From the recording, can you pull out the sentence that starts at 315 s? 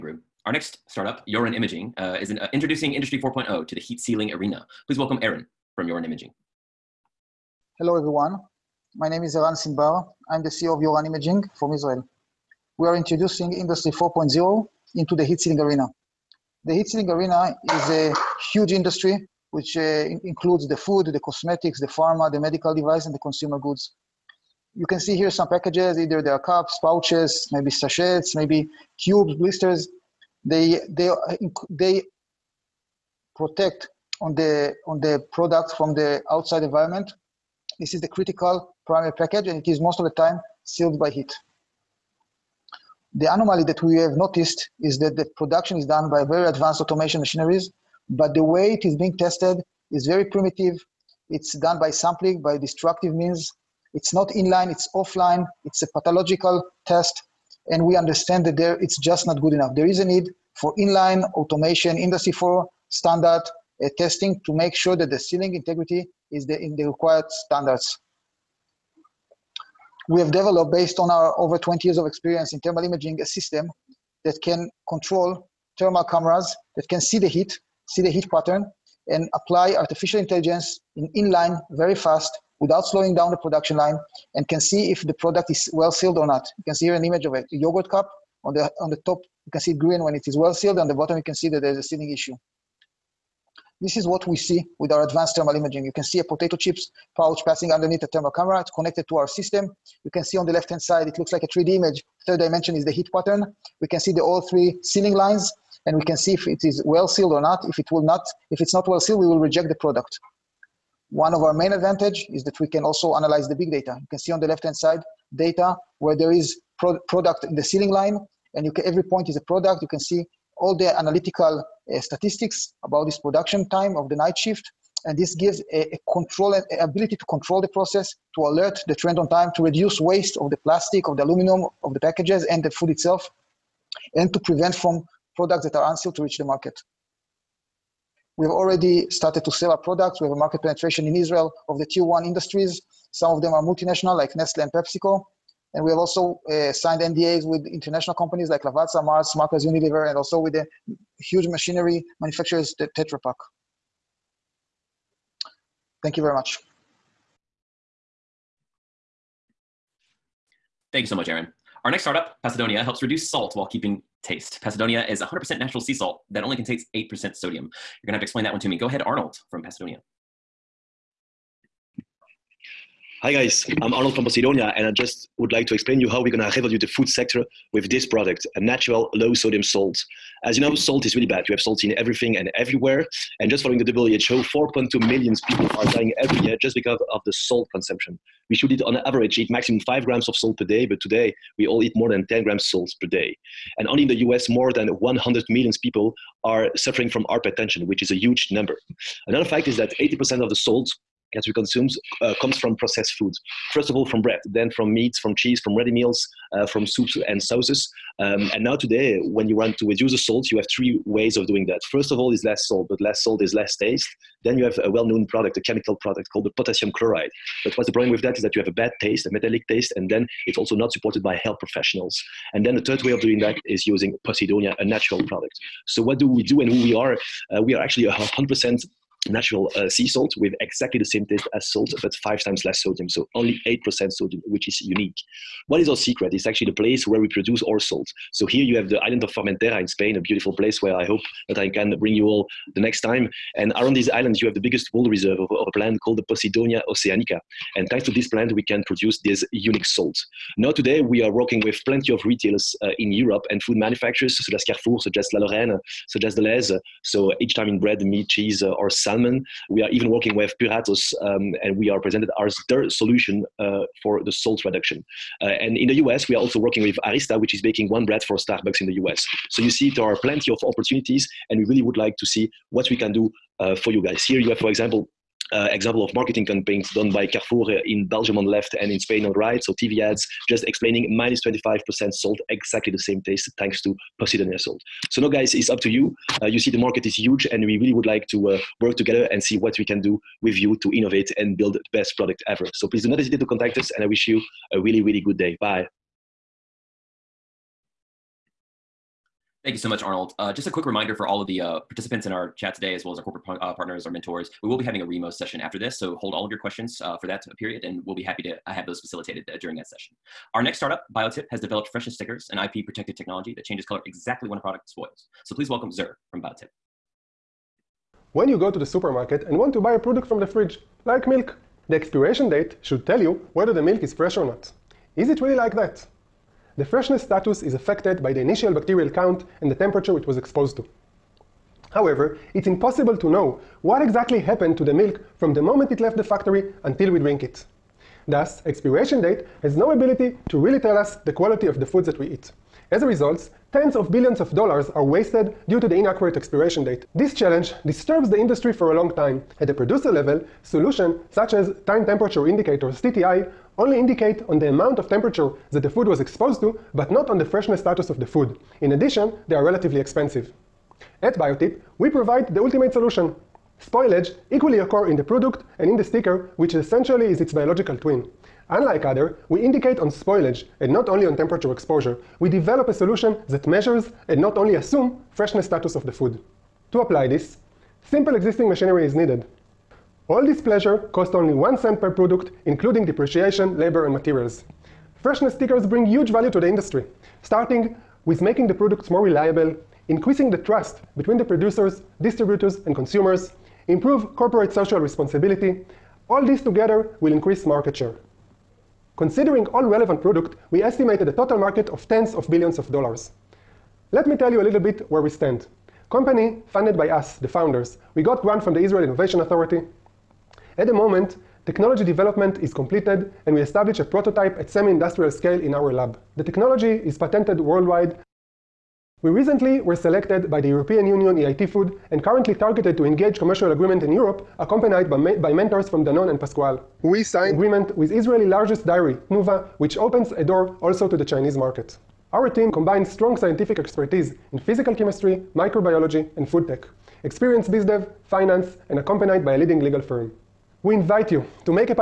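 So please welcome Zer from Biotip.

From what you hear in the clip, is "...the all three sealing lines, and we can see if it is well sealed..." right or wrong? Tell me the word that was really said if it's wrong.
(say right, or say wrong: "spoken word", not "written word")
right.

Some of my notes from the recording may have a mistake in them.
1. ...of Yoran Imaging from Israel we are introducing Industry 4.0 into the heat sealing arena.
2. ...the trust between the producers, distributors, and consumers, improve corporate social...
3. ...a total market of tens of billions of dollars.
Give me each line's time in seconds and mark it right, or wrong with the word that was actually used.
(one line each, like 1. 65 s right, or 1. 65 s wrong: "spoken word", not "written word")
1. 10 s right
2. 390 s right
3. 401 s right.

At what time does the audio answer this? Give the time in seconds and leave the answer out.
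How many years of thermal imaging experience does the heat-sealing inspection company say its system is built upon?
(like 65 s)
71 s.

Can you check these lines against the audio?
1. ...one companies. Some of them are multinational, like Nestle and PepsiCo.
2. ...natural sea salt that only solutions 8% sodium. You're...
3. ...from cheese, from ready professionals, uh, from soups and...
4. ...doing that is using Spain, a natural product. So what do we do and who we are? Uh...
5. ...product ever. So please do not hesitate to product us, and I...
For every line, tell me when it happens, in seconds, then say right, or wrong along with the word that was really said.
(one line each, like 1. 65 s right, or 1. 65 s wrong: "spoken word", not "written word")
1. 142 s wrong: "industries", not "companies"
2. 165 s wrong: "contains", not "solutions"
3. 205 s wrong: "meals", not "professionals"
4. 223 s wrong: "Posidonia", not "Spain"
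5. 292 s wrong: "contact", not "product".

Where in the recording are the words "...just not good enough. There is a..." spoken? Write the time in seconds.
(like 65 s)
59 s.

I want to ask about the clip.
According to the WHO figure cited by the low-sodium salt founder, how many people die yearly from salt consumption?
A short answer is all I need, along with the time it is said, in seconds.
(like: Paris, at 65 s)
4.2 million, at 184 s.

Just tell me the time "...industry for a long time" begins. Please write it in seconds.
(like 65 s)
348 s.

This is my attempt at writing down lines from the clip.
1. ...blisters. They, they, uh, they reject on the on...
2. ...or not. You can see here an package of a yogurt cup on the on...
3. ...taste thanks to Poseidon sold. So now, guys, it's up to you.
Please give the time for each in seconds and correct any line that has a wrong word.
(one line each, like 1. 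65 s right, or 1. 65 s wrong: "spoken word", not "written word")
1. 29 s wrong: "protect", not "reject"
2. 86 s wrong: "image", not "package"
3. 283 s right.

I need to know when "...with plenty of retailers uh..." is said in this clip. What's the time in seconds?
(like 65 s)
251 s.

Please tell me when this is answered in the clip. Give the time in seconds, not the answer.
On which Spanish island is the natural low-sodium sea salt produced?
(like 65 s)
239 s.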